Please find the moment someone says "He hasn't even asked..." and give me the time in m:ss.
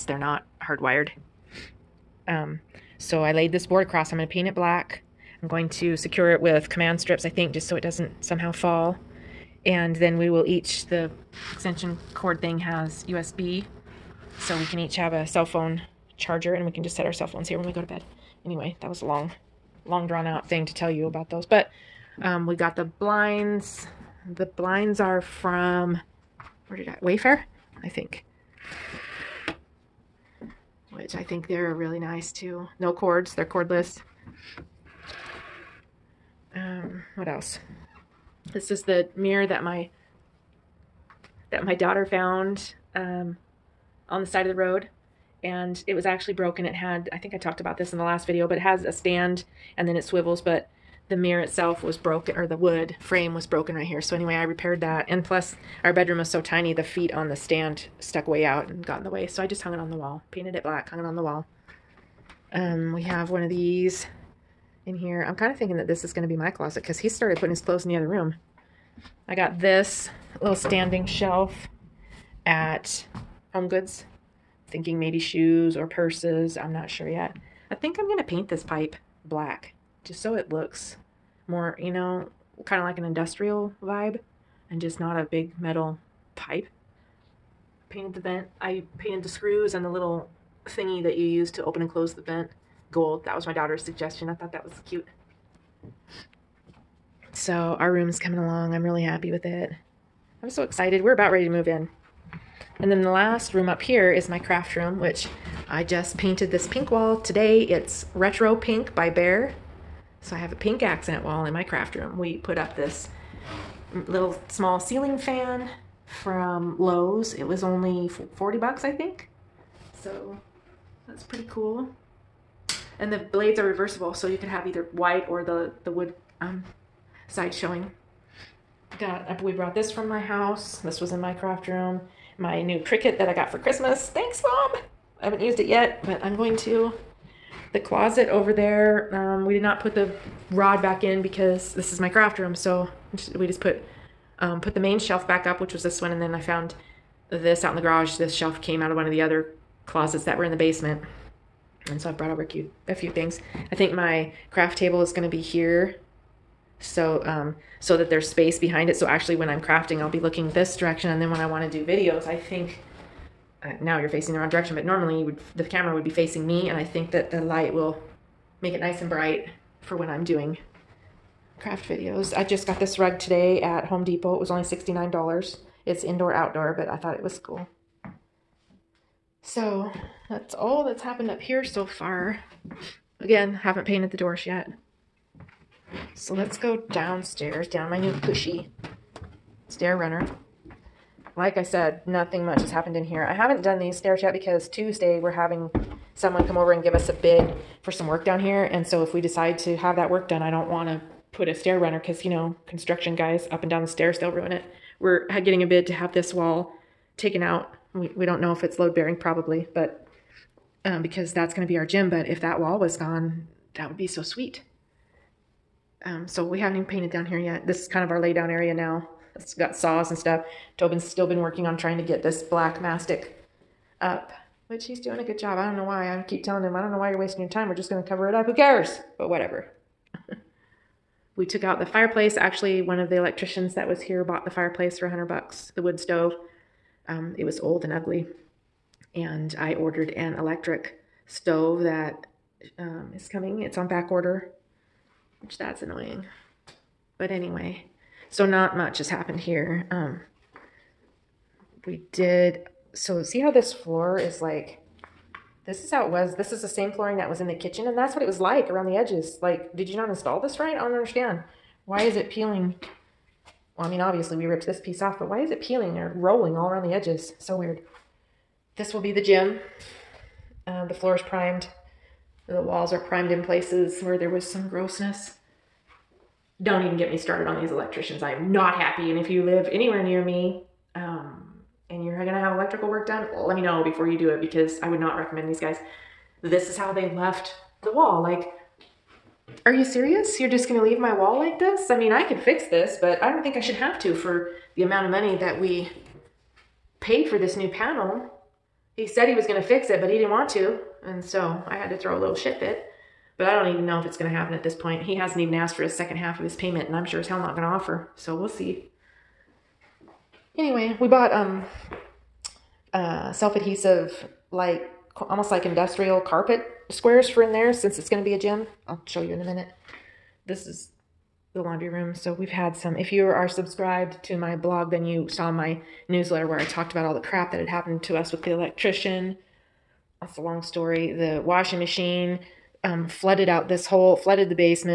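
5:05.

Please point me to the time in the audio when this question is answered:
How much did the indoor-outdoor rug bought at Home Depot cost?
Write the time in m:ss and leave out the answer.
2:54.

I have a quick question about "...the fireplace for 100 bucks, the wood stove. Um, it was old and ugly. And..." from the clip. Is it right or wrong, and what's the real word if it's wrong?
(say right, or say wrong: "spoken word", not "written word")
right.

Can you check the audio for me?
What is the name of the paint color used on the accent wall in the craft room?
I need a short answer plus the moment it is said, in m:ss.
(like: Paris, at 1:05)
Retro Pink, at 1:48.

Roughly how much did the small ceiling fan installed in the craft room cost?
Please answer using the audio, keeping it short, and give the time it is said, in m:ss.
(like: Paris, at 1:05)
$40, at 1:58.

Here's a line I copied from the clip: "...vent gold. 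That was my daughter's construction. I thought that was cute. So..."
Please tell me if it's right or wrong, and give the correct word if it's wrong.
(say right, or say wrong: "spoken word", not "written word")
wrong: "suggestion", not "construction".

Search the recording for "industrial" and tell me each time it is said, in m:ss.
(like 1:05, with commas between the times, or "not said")
1:23, 5:15.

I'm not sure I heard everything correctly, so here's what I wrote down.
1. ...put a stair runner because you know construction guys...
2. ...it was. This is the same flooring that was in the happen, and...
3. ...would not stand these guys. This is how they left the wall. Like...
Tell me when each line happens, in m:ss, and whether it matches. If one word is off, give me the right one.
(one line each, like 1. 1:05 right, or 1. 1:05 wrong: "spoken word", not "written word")
1. 3:21 right
2. 4:16 wrong: "kitchen", not "happen"
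3. 4:44 wrong: "recommend", not "stand".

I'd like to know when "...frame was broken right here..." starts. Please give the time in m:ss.
0:52.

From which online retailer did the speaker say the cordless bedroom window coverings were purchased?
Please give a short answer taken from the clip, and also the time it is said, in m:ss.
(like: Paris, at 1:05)
Wayfair, at 0:27.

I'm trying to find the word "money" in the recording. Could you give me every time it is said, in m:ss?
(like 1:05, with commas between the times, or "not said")
4:55.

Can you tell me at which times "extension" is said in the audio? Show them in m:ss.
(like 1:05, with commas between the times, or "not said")
0:11.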